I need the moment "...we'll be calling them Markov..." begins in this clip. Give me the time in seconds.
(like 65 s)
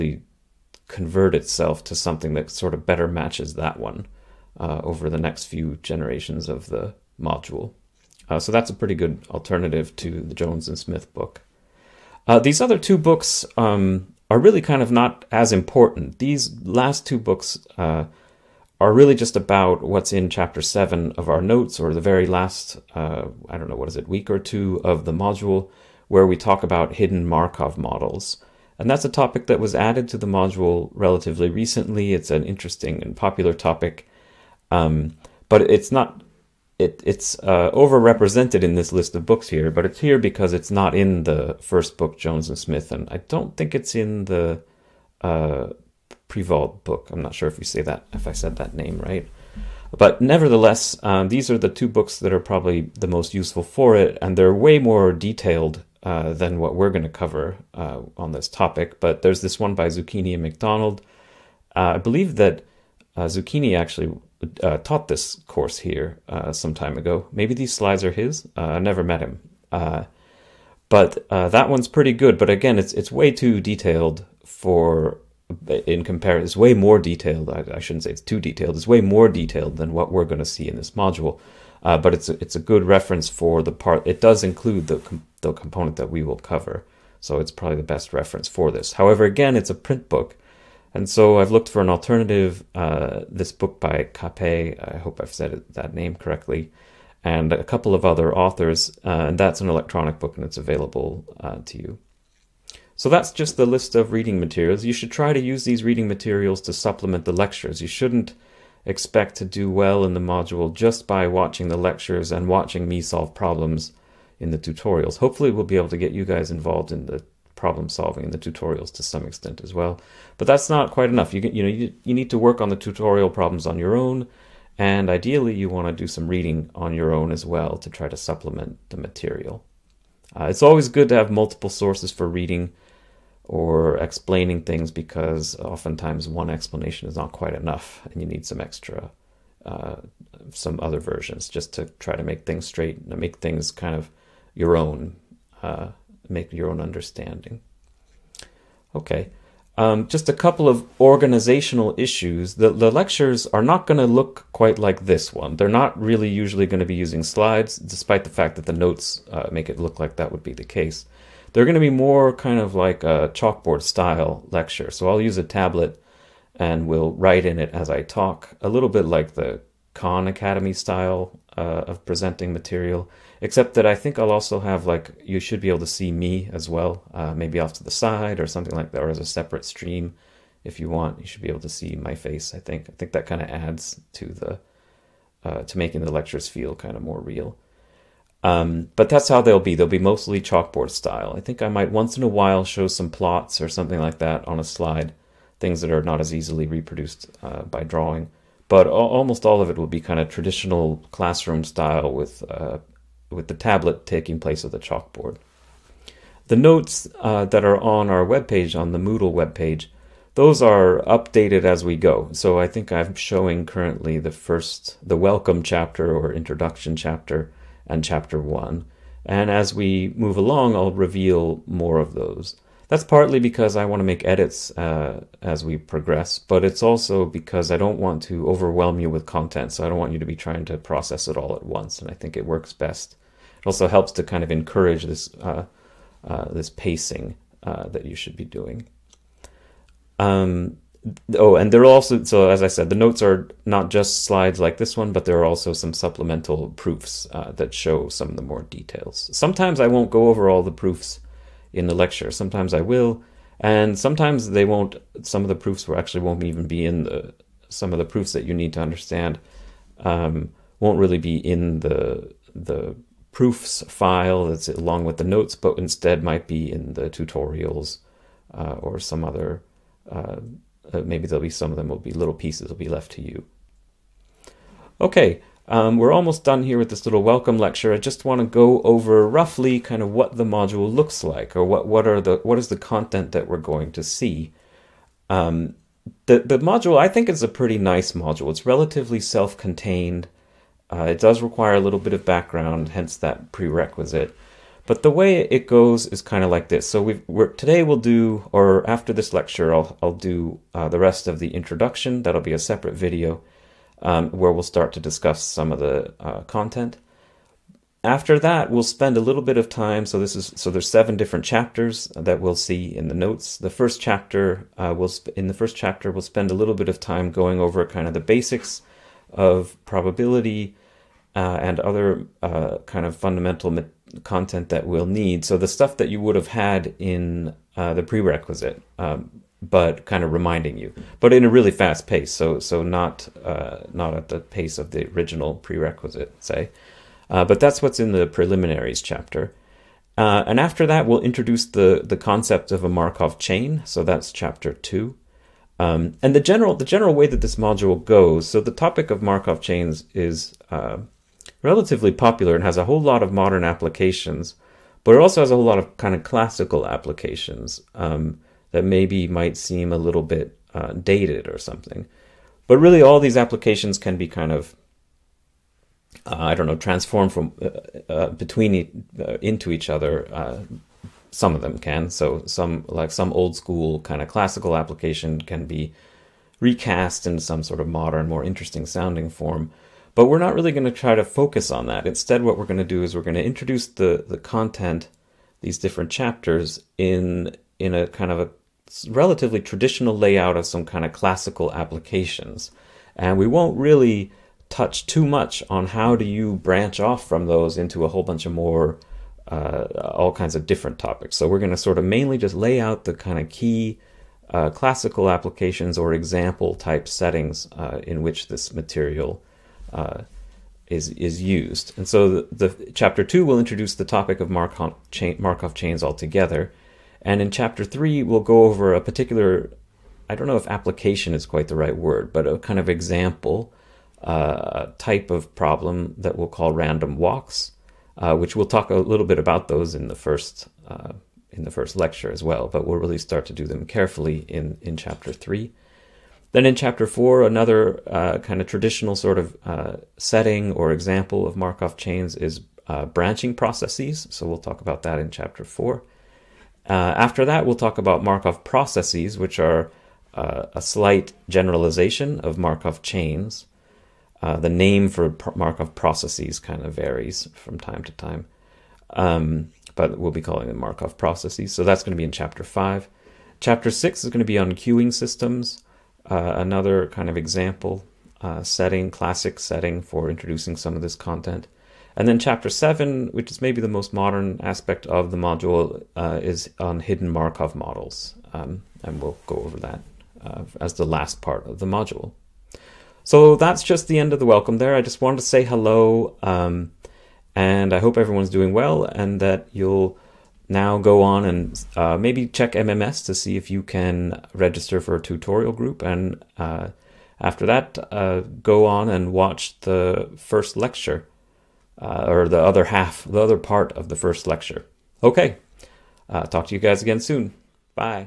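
460 s.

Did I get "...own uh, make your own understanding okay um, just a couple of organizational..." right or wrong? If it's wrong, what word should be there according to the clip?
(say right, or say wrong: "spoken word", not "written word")
right.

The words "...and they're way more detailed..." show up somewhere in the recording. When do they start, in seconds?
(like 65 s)
54 s.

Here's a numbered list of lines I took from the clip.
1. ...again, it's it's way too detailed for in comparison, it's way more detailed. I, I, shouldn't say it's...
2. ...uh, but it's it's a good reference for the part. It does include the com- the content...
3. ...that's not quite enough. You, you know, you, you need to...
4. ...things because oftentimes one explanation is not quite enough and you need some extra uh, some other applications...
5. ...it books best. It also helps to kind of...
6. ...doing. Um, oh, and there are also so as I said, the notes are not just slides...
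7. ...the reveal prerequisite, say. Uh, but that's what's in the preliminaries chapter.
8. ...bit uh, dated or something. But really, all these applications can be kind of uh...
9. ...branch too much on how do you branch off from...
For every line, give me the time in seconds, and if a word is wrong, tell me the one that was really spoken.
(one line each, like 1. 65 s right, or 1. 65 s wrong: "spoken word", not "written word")
1. 72 s right
2. 81 s wrong: "component", not "content"
3. 120 s right
4. 134 s wrong: "versions", not "applications"
5. 232 s wrong: "works", not "books"
6. 238 s right
7. 334 s wrong: "original", not "reveal"
8. 360 s right
9. 394 s wrong: "touch", not "branch".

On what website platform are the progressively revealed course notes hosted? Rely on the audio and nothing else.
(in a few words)
Moodle.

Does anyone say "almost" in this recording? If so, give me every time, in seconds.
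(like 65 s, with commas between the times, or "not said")
198 s, 276 s.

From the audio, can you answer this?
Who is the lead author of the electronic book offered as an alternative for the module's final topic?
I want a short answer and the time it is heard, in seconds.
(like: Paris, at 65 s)
Cappé, at 94 s.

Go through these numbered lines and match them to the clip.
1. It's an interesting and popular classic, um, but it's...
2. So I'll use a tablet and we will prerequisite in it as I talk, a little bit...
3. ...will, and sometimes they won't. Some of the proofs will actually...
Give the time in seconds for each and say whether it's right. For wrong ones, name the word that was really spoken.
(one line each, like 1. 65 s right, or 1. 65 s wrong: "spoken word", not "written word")
1. 32 s wrong: "topic", not "classic"
2. 164 s wrong: "write", not "prerequisite"
3. 252 s right.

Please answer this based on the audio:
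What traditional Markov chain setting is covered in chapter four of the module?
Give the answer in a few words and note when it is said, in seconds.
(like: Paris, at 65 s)
branching processes, at 443 s.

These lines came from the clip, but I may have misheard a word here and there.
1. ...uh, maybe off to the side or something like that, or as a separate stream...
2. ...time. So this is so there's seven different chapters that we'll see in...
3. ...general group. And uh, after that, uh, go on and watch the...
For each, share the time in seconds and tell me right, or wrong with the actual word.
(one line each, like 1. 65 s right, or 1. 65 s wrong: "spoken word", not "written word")
1. 177 s right
2. 309 s right
3. 495 s wrong: "tutorial", not "general".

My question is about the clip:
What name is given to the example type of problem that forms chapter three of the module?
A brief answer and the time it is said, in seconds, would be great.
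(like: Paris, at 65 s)
random walks, at 426 s.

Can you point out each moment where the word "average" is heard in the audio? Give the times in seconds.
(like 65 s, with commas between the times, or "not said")
not said.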